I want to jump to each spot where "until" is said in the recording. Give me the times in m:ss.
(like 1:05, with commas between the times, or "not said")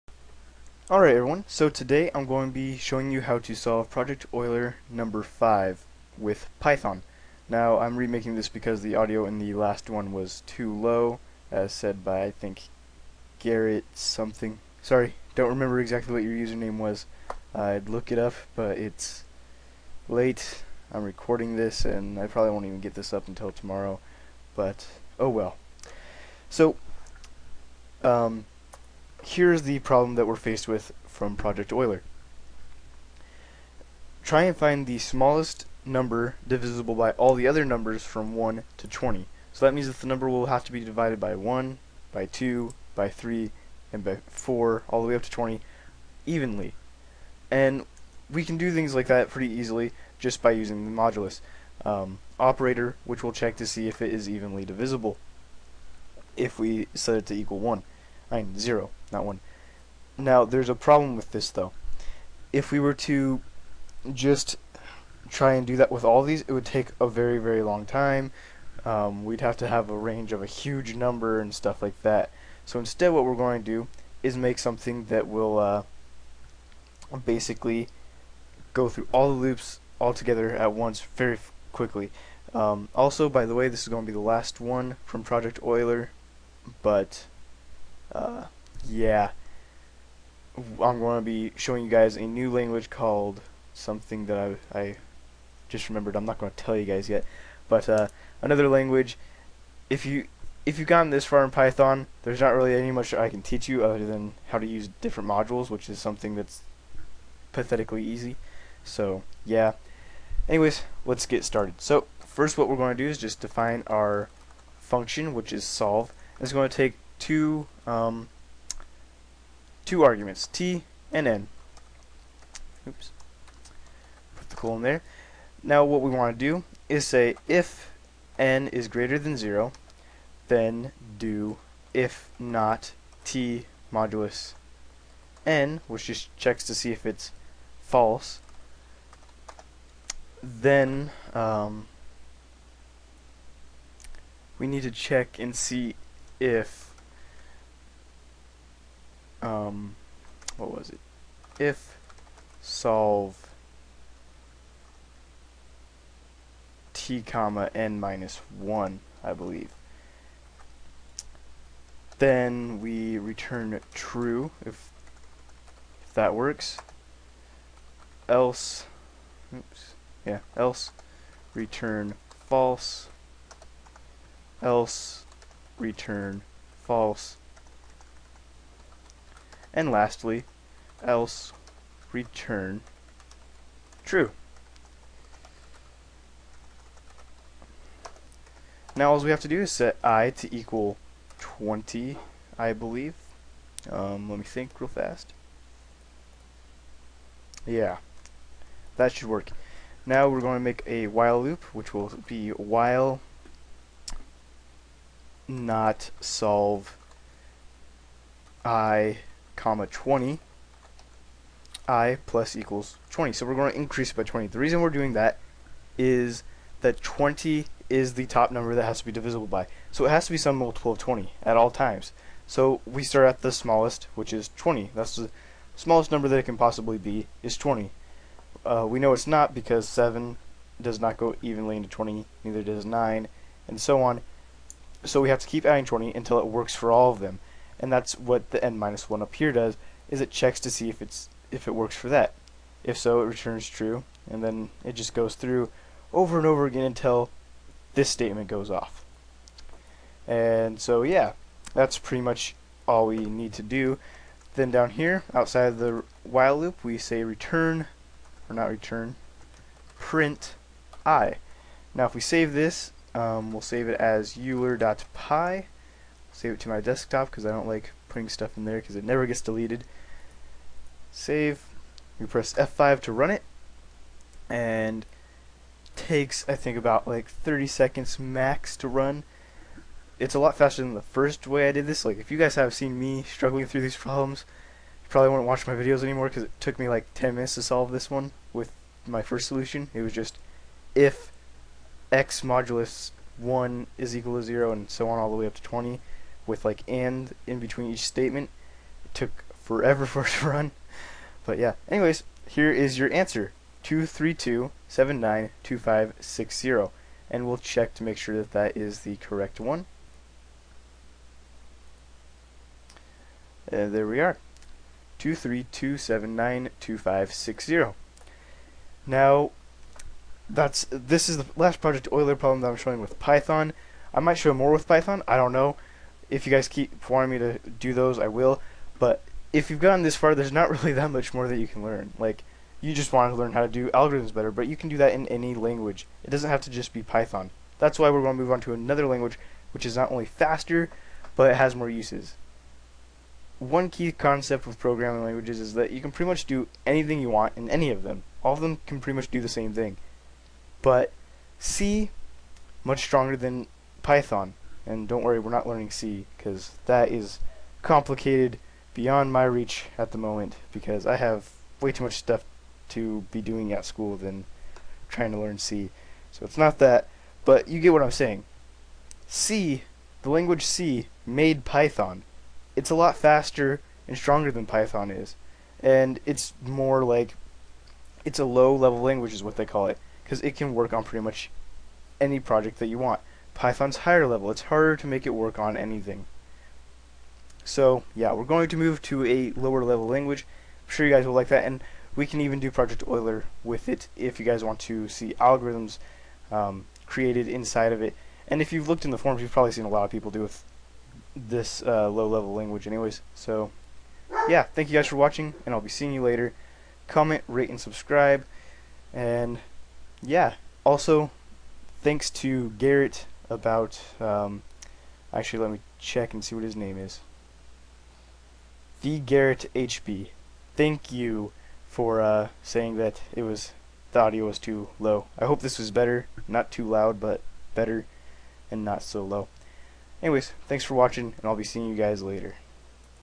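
0:23, 3:56, 4:06.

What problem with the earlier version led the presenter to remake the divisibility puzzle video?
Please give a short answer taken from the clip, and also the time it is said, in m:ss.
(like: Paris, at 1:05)
audio was too low, at 0:08.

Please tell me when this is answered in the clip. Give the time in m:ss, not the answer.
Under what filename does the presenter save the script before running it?
4:24.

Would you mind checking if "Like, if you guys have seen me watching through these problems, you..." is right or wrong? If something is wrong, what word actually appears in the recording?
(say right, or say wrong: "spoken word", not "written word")
wrong: "struggling", not "watching".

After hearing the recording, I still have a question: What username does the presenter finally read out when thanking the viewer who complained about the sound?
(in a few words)
Garrett HB.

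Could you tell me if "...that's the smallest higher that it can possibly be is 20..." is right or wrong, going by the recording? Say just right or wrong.
wrong.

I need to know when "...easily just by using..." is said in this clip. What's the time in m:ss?
0:49.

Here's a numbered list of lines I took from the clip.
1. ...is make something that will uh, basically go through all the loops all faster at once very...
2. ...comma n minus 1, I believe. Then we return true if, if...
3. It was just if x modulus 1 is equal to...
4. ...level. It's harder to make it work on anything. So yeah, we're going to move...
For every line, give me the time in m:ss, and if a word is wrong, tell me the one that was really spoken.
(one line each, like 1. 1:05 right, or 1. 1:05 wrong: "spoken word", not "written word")
1. 1:14 wrong: "together", not "faster"
2. 2:37 right
3. 4:49 right
4. 6:24 right.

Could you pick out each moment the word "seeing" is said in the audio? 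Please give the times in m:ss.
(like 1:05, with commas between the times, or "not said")
6:45, 7:11.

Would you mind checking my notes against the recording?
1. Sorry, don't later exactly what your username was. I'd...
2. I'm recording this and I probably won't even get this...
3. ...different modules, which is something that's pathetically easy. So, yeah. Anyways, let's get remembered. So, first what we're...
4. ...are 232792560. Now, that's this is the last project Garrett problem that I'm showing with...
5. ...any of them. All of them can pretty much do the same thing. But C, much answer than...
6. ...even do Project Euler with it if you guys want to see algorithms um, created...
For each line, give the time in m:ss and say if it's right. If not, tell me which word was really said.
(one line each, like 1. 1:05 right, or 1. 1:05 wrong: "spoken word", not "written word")
1. 0:14 wrong: "remember", not "later"
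2. 0:20 right
3. 1:44 wrong: "started", not "remembered"
4. 5:14 wrong: "Euler", not "Garrett"
5. 5:47 wrong: "stronger", not "answer"
6. 6:32 right.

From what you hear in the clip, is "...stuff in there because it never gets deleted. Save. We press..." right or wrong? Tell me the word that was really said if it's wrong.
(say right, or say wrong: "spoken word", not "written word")
right.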